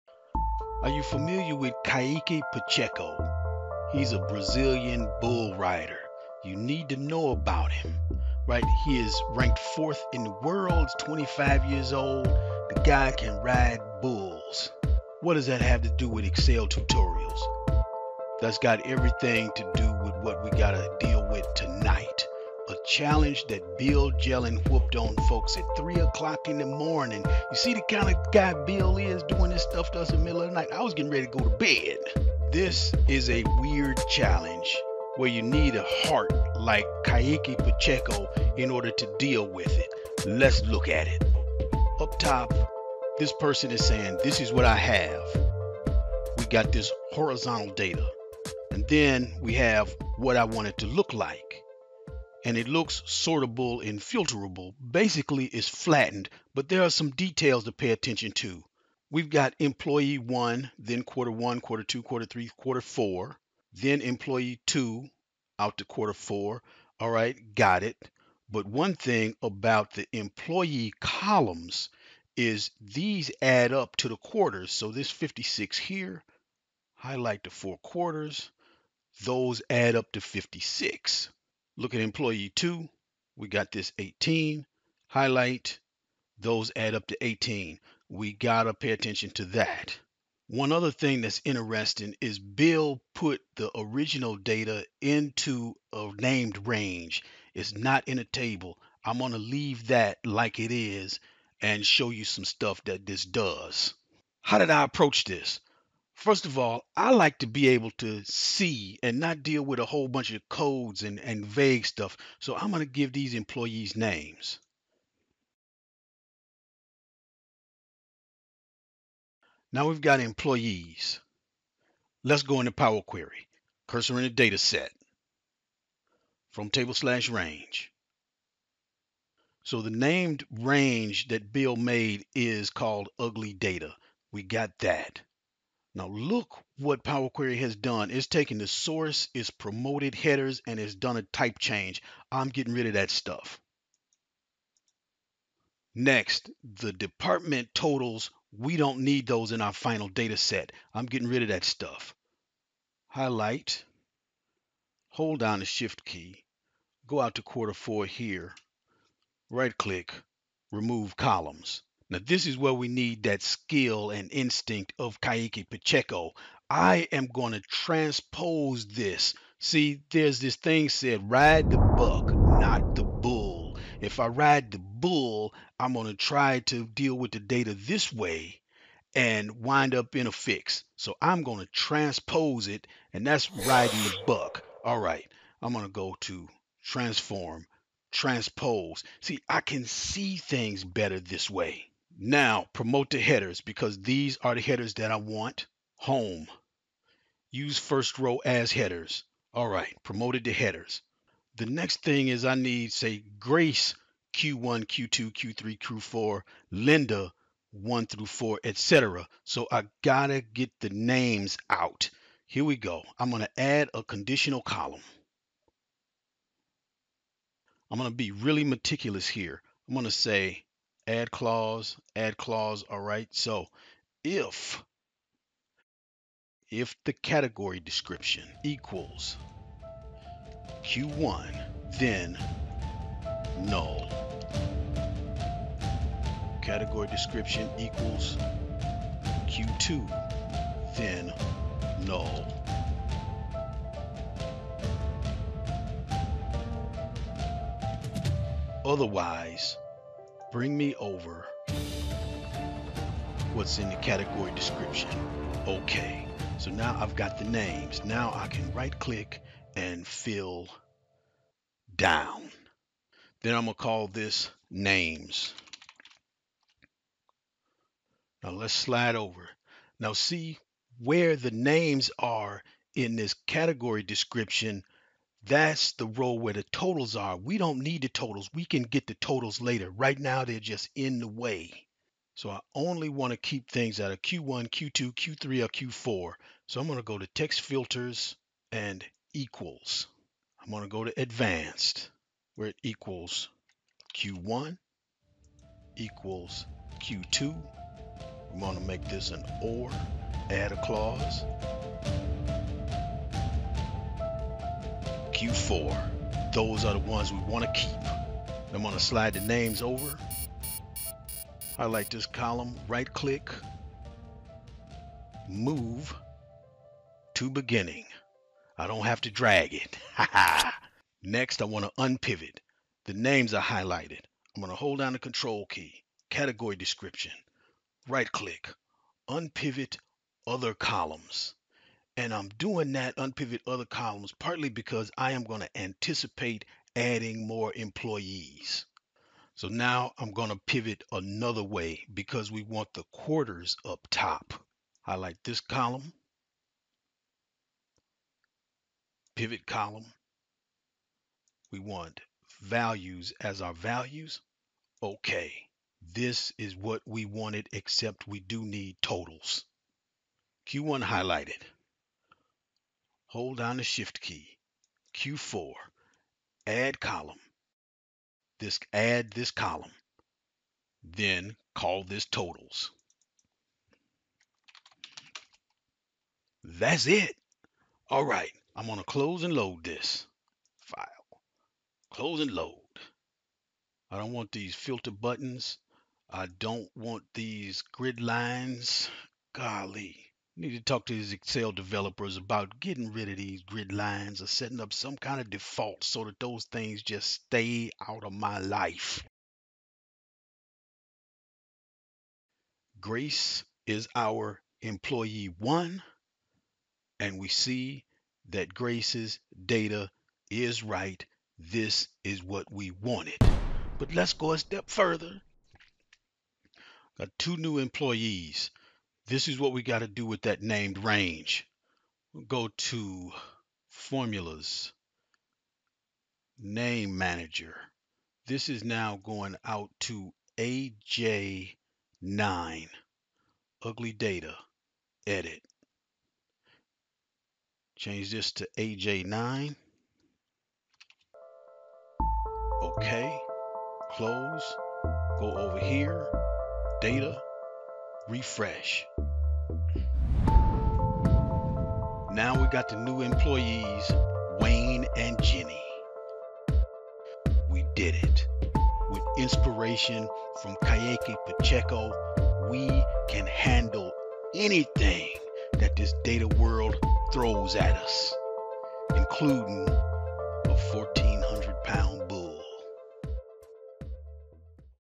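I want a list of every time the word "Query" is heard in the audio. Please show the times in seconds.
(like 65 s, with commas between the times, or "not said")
123 s, 137 s.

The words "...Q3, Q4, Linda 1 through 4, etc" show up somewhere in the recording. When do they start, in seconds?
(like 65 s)
205 s.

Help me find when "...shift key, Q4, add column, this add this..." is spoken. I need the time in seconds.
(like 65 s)
363 s.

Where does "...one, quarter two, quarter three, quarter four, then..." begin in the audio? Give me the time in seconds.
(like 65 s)
61 s.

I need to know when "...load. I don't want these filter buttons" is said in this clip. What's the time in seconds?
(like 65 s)
382 s.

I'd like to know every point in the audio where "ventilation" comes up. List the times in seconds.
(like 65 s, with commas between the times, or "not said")
not said.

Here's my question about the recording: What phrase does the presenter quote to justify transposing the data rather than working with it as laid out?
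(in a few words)
ride the buck, not the bull.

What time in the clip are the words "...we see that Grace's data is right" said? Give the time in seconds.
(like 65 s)
407 s.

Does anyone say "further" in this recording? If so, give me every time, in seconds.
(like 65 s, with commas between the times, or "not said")
414 s.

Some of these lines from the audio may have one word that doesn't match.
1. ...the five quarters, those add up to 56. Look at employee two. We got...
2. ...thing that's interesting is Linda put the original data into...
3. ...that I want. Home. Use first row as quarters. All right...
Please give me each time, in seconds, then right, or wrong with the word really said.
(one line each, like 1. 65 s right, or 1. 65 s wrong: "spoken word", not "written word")
1. 77 s wrong: "four", not "five"
2. 90 s wrong: "Bill", not "Linda"
3. 194 s wrong: "headers", not "quarters".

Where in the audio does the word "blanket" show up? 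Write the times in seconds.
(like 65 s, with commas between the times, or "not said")
not said.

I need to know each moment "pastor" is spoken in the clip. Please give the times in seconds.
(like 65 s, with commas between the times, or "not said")
not said.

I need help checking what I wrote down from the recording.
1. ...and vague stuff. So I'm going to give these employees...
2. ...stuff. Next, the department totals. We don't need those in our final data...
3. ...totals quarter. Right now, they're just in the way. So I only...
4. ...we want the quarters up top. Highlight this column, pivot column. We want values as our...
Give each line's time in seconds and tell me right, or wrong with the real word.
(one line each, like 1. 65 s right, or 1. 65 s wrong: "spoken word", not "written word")
1. 111 s right
2. 143 s right
3. 279 s wrong: "later", not "quarter"
4. 342 s right.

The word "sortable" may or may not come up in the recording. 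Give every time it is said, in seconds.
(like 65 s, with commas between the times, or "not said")
53 s.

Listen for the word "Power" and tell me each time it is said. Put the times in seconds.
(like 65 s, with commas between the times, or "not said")
122 s, 137 s.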